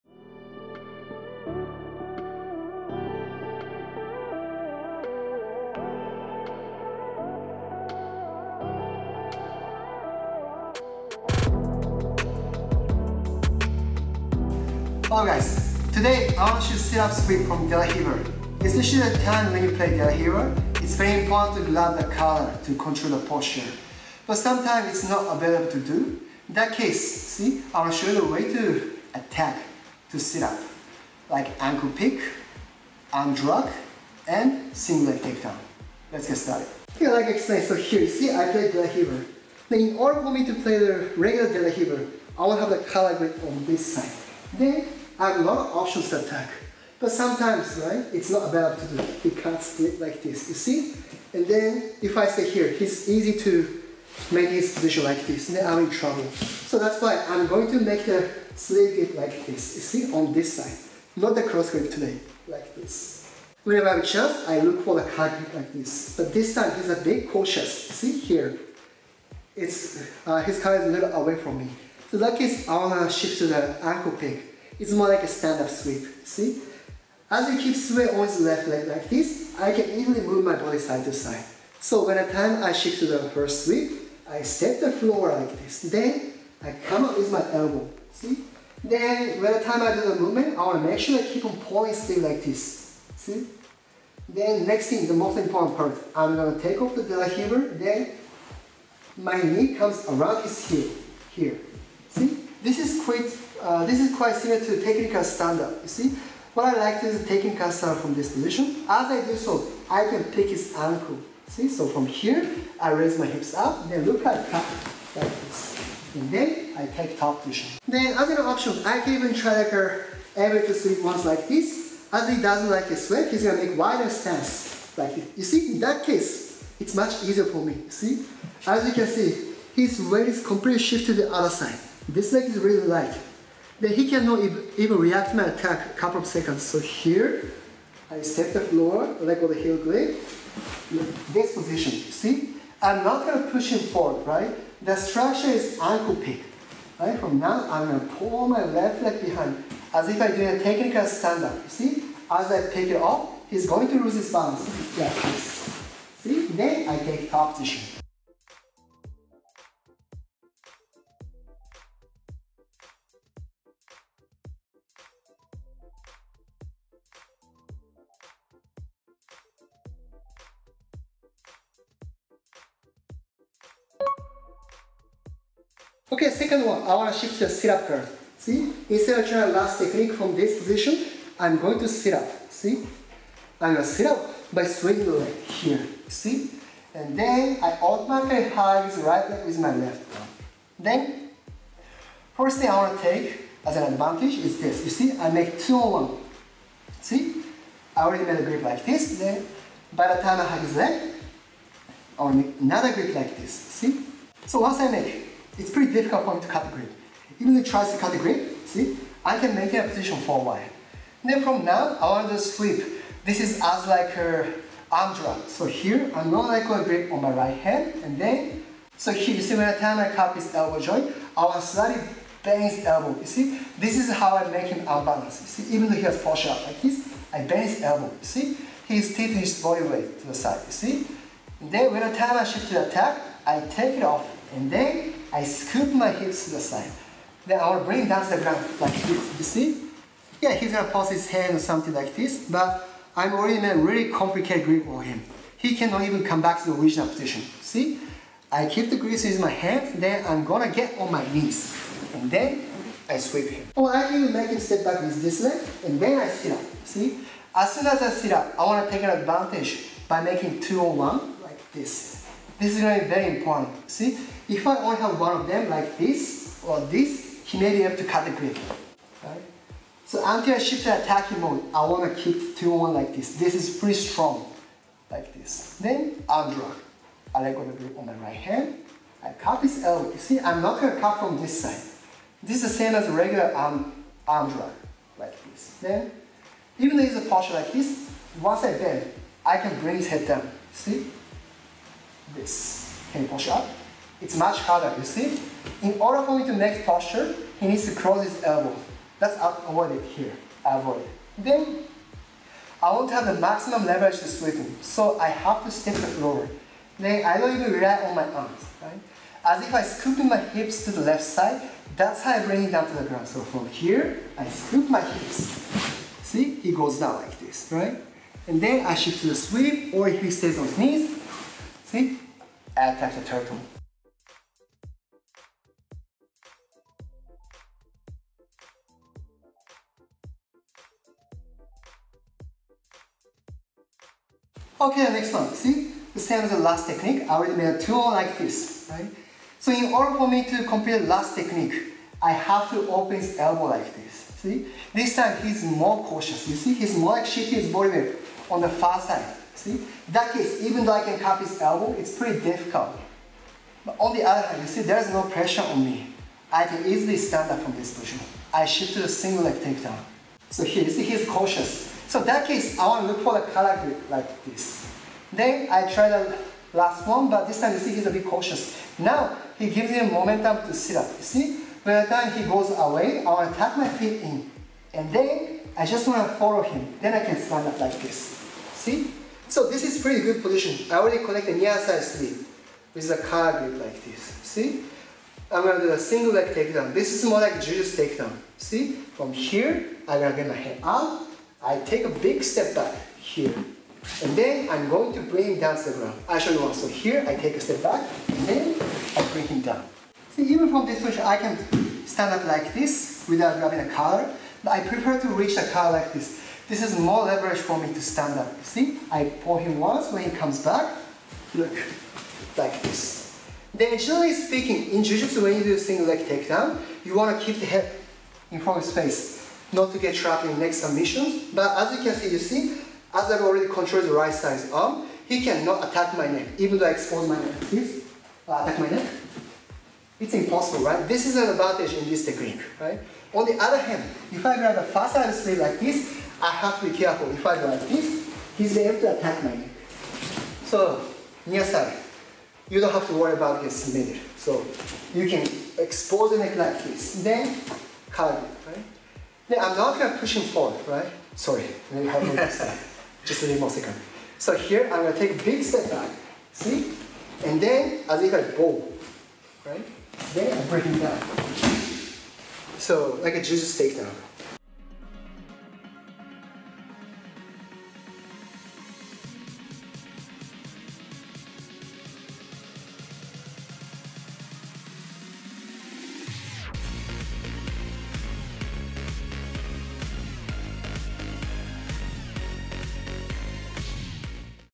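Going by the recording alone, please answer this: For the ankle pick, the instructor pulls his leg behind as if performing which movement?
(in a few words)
technical stand-up.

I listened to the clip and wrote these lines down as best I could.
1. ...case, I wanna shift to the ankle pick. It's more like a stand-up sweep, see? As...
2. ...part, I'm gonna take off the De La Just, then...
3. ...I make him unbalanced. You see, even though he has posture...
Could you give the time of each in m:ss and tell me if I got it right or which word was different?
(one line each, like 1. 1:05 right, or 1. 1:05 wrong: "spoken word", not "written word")
1. 1:12 right
2. 1:35 wrong: "Riva", not "Just"
3. 3:44 right.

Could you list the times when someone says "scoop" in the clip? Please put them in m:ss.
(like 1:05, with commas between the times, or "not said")
3:55, 5:09, 5:14.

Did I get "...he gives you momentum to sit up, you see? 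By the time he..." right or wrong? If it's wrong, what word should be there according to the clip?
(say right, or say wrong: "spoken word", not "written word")
right.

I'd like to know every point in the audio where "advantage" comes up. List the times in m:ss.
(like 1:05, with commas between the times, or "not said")
3:13, 4:19, 7:11.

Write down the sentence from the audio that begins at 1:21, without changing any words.
So when the time I shift to the first sweep, I step the floor like this.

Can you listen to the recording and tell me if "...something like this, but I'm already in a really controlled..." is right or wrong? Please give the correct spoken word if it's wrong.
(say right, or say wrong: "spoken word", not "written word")
wrong: "complicated", not "controlled".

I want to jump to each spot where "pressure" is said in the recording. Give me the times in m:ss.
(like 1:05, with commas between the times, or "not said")
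5:55.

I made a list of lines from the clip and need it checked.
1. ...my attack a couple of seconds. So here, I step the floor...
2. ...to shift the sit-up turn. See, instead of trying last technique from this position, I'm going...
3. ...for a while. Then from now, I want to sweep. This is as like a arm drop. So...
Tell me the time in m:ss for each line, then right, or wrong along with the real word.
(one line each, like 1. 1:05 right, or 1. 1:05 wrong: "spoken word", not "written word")
1. 2:15 right
2. 2:57 right
3. 3:30 right.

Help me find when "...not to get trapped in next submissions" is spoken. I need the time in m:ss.
6:59.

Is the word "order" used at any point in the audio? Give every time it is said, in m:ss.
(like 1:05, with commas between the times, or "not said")
0:39, 4:55, 5:39.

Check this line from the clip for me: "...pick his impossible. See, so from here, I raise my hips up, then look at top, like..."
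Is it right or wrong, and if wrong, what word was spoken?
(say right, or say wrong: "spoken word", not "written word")
wrong: "ankle", not "impossible".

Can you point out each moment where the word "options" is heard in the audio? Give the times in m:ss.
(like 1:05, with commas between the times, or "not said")
0:45, 1:58.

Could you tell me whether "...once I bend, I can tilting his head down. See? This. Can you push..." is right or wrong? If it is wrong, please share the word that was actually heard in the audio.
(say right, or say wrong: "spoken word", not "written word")
wrong: "bring", not "tilting".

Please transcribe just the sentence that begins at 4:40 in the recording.
You see, I'm not going to cut from this side.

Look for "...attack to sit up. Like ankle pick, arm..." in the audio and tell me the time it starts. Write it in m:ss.
0:29.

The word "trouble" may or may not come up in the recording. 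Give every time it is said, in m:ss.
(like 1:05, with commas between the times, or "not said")
0:55.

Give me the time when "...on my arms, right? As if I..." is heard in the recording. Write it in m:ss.
5:08.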